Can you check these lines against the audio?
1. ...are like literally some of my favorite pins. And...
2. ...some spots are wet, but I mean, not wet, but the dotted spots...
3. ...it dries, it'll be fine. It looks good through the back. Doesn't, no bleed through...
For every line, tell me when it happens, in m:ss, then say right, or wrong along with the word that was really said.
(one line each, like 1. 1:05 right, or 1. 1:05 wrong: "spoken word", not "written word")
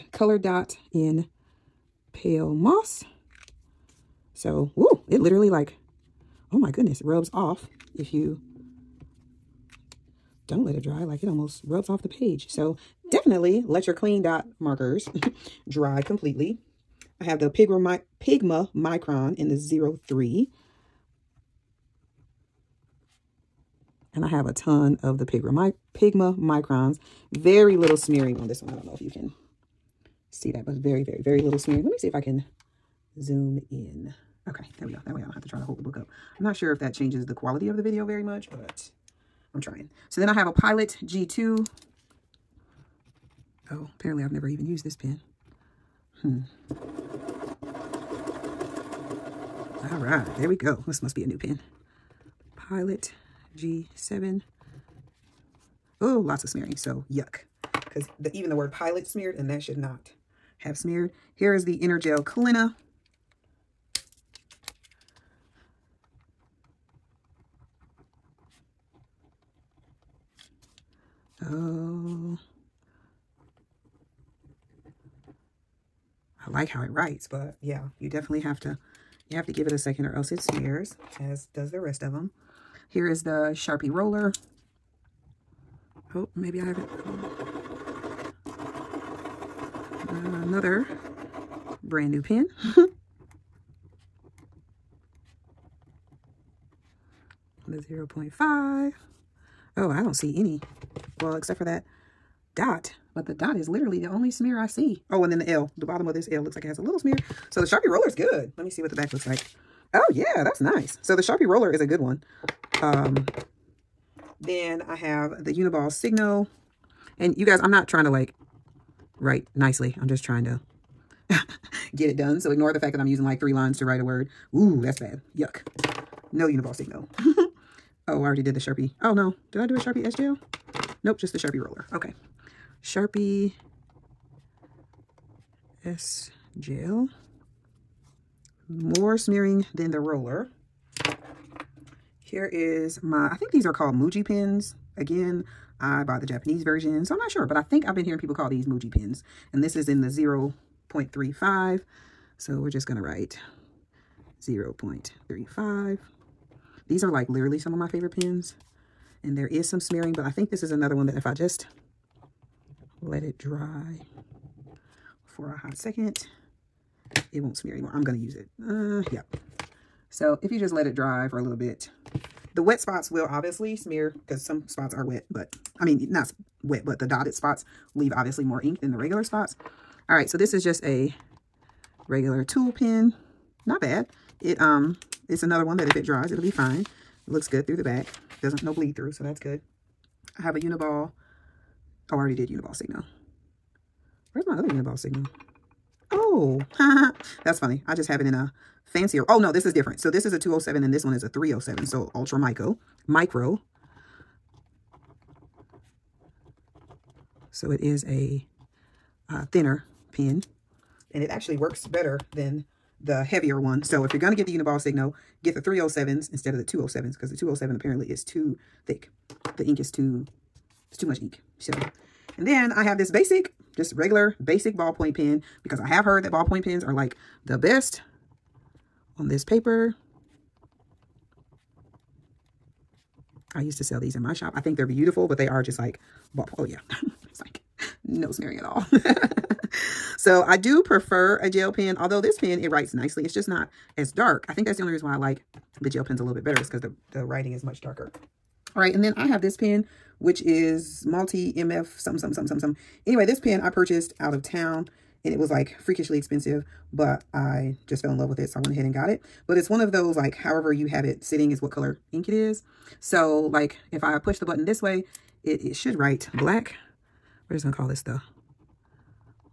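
1. 2:37 right
2. 2:54 right
3. 3:05 right.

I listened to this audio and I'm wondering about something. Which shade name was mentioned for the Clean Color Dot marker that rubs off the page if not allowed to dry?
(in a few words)
Pale Moss.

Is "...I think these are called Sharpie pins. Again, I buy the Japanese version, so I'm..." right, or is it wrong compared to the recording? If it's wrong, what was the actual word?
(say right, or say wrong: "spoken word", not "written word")
wrong: "Muji", not "Sharpie".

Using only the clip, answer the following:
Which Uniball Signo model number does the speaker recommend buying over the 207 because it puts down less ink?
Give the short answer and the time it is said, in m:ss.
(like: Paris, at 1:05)
307, at 3:35.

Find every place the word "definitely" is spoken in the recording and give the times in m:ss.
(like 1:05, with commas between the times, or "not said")
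0:13, 1:18.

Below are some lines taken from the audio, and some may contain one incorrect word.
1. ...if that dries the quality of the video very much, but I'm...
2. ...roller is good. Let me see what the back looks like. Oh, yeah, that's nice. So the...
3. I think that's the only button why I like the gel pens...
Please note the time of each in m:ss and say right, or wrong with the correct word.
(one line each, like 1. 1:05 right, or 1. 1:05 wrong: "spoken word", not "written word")
1. 0:36 wrong: "changes", not "dries"
2. 1:47 right
3. 4:04 wrong: "reason", not "button".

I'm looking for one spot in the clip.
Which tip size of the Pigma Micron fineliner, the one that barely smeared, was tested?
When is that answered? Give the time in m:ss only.
0:20.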